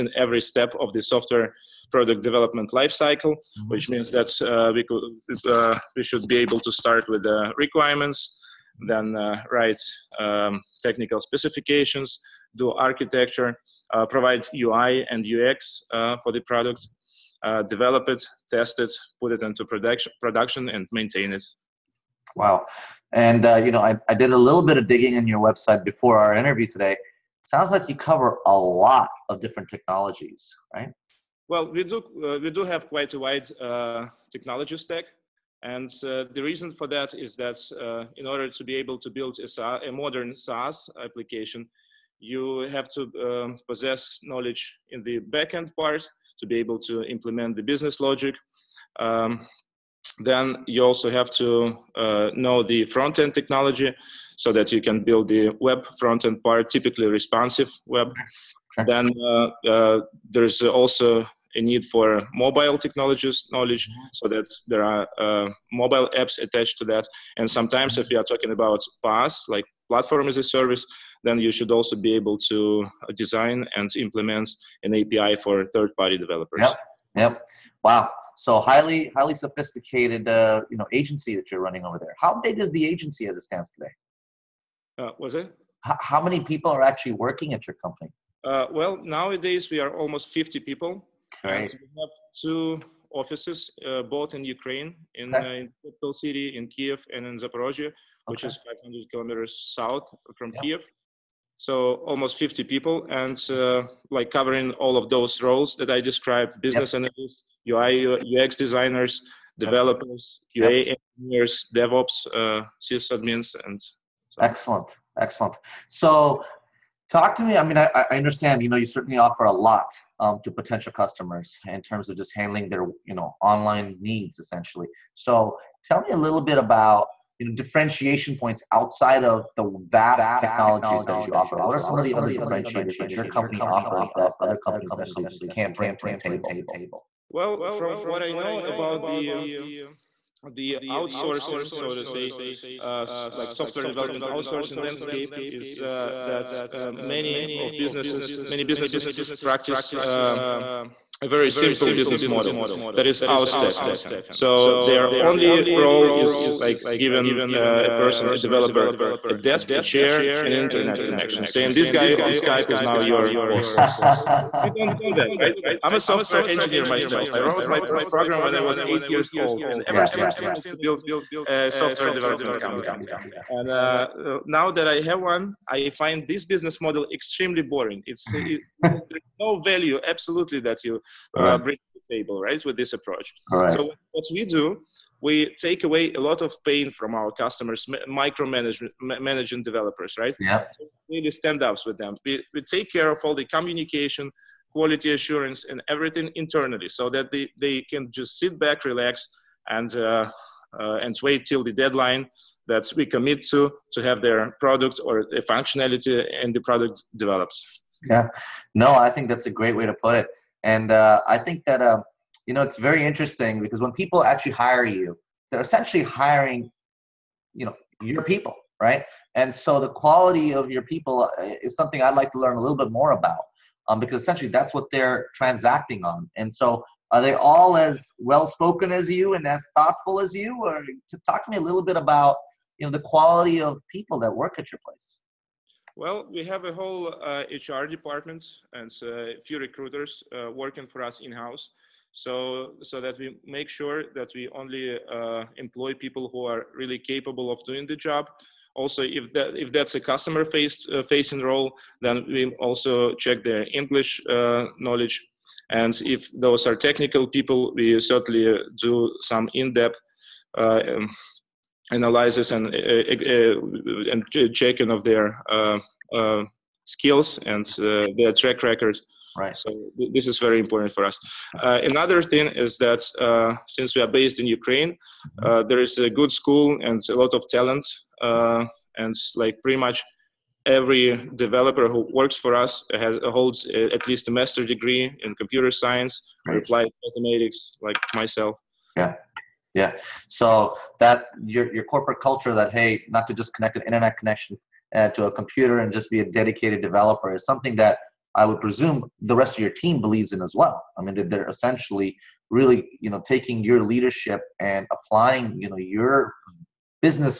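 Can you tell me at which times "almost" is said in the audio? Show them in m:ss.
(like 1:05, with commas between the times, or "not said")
1:29, 1:42.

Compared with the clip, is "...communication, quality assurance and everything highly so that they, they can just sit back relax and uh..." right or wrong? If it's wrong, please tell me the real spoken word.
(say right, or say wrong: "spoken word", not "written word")
wrong: "internally", not "highly".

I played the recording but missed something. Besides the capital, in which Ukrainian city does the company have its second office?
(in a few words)
Zaporozhye.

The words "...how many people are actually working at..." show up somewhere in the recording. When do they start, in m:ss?
1:26.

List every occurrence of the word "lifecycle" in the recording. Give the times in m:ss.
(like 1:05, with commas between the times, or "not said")
0:02.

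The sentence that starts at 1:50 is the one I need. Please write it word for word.
QA engineers, DevOps, uh, sysadmins, and so.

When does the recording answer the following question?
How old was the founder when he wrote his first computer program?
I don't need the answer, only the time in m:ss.
2:48.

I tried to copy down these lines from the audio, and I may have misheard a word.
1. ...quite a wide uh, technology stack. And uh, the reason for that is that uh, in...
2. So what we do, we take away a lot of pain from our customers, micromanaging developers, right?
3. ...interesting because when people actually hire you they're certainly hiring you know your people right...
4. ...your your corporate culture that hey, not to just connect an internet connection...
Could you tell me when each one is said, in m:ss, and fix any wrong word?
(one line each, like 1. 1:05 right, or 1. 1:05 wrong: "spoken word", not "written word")
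1. 0:32 right
2. 3:03 right
3. 3:33 wrong: "essentially", not "certainly"
4. 4:51 right.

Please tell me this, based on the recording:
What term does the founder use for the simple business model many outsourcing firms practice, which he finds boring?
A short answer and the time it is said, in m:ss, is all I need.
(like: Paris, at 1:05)
outstaffing, at 2:33.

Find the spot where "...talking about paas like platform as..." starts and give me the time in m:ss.
1:08.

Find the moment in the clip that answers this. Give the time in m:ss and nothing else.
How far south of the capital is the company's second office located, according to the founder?
1:38.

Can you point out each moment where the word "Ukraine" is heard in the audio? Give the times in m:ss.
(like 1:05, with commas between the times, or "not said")
1:34, 4:34.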